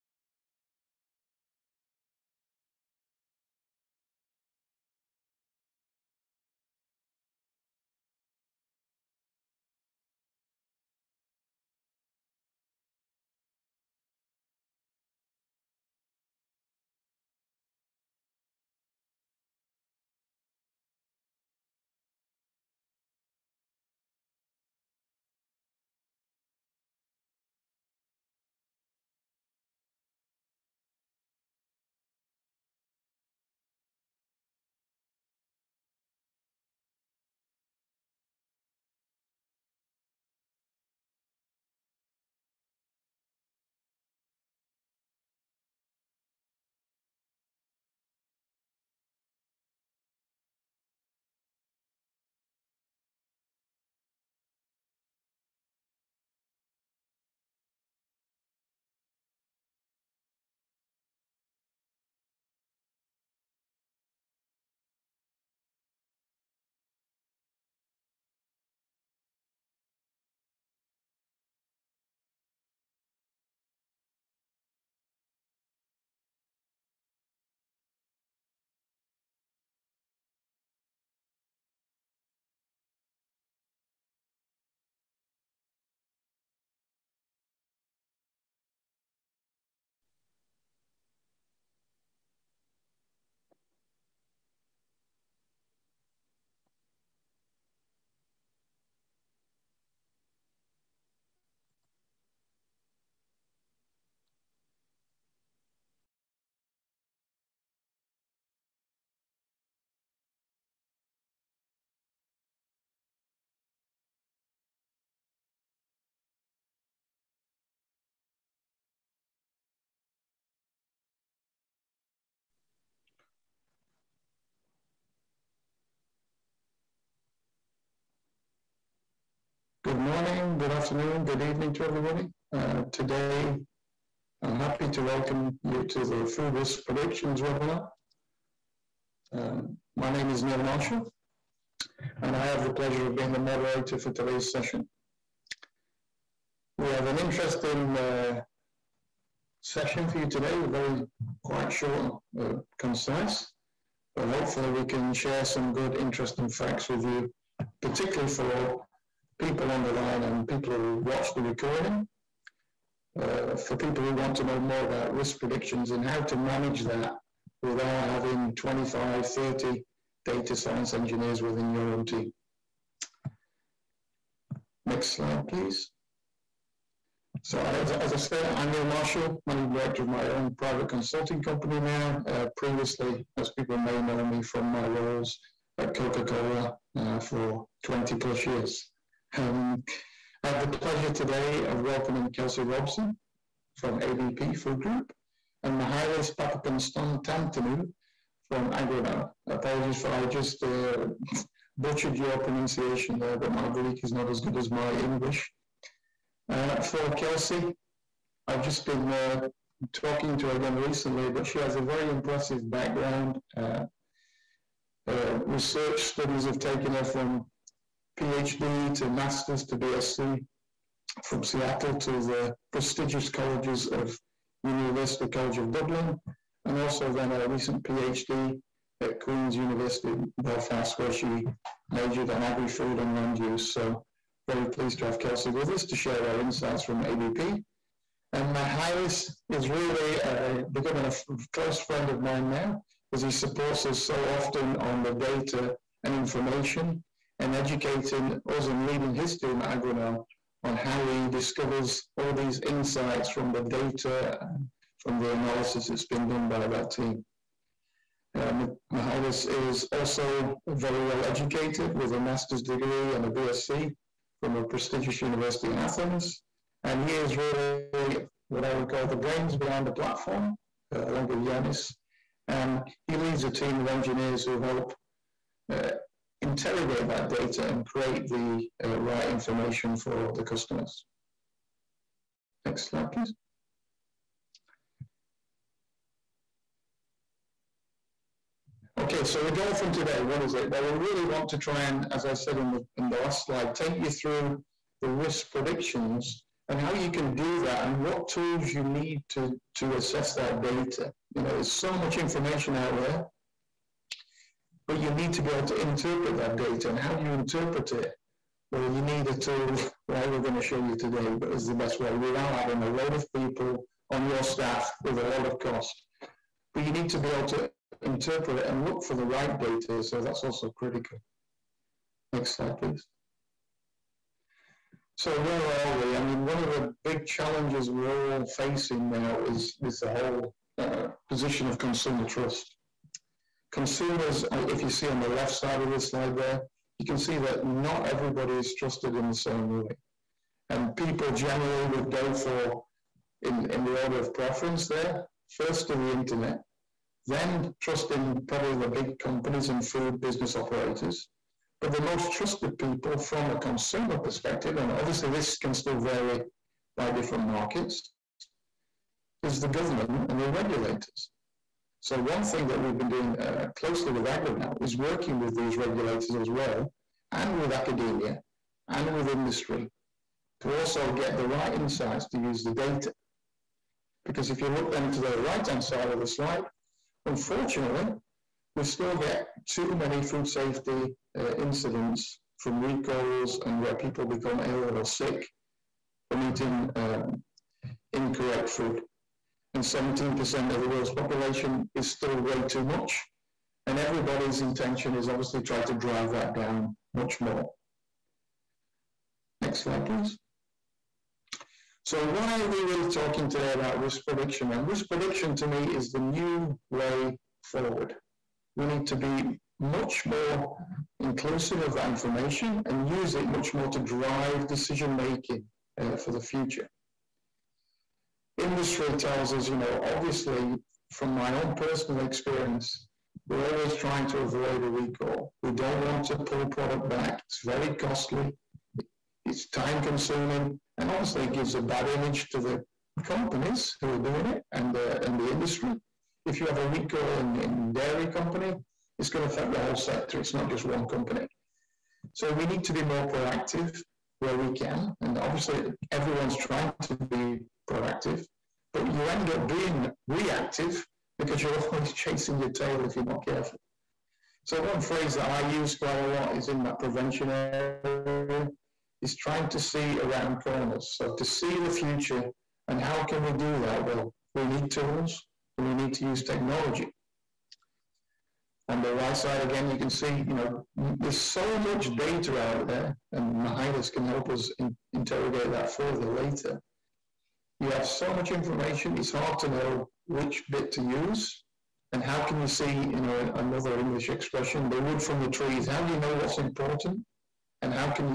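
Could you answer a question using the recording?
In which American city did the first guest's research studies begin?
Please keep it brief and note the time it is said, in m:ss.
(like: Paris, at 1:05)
Seattle, at 3:41.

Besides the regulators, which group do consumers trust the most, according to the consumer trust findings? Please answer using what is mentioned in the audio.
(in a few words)
the government.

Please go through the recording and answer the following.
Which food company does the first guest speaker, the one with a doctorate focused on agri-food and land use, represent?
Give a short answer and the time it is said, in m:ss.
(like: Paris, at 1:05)
ABP Food Group, at 3:14.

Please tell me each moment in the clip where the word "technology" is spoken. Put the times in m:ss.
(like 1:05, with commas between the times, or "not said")
7:46.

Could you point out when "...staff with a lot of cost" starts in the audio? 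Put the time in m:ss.
5:14.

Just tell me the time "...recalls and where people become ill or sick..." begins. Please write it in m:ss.
6:22.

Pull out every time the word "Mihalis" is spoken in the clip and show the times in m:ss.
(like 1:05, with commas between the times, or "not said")
3:15, 3:58, 7:53.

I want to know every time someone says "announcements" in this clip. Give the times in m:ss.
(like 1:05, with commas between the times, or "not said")
not said.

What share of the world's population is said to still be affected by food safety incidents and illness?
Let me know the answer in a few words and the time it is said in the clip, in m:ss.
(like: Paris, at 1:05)
17%, at 6:29.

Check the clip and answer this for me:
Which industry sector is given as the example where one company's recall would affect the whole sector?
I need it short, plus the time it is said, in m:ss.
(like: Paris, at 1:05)
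dairy, at 7:17.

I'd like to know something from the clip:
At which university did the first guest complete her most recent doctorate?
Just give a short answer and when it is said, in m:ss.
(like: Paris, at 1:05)
Queen's University in Belfast, at 3:49.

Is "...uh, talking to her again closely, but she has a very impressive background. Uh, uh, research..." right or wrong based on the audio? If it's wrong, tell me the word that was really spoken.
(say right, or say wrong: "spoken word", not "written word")
wrong: "recently", not "closely".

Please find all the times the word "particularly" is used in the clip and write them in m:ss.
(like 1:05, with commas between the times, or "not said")
2:37.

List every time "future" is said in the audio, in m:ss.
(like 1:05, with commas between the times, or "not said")
6:56, 7:41.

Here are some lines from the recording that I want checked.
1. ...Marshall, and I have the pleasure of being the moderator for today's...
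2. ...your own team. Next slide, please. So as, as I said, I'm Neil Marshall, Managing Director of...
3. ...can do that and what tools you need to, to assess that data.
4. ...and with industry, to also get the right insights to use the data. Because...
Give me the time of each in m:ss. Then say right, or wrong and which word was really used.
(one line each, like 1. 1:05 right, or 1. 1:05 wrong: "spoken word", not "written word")
1. 2:20 right
2. 2:51 right
3. 4:57 right
4. 6:08 right.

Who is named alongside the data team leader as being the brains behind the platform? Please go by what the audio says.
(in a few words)
Yanis.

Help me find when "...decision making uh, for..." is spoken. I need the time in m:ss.
6:54.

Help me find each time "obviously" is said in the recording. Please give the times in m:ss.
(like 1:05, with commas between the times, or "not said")
5:54, 6:35, 7:00, 7:11, 7:25.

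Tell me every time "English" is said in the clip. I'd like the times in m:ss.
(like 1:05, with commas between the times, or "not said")
3:24, 8:03.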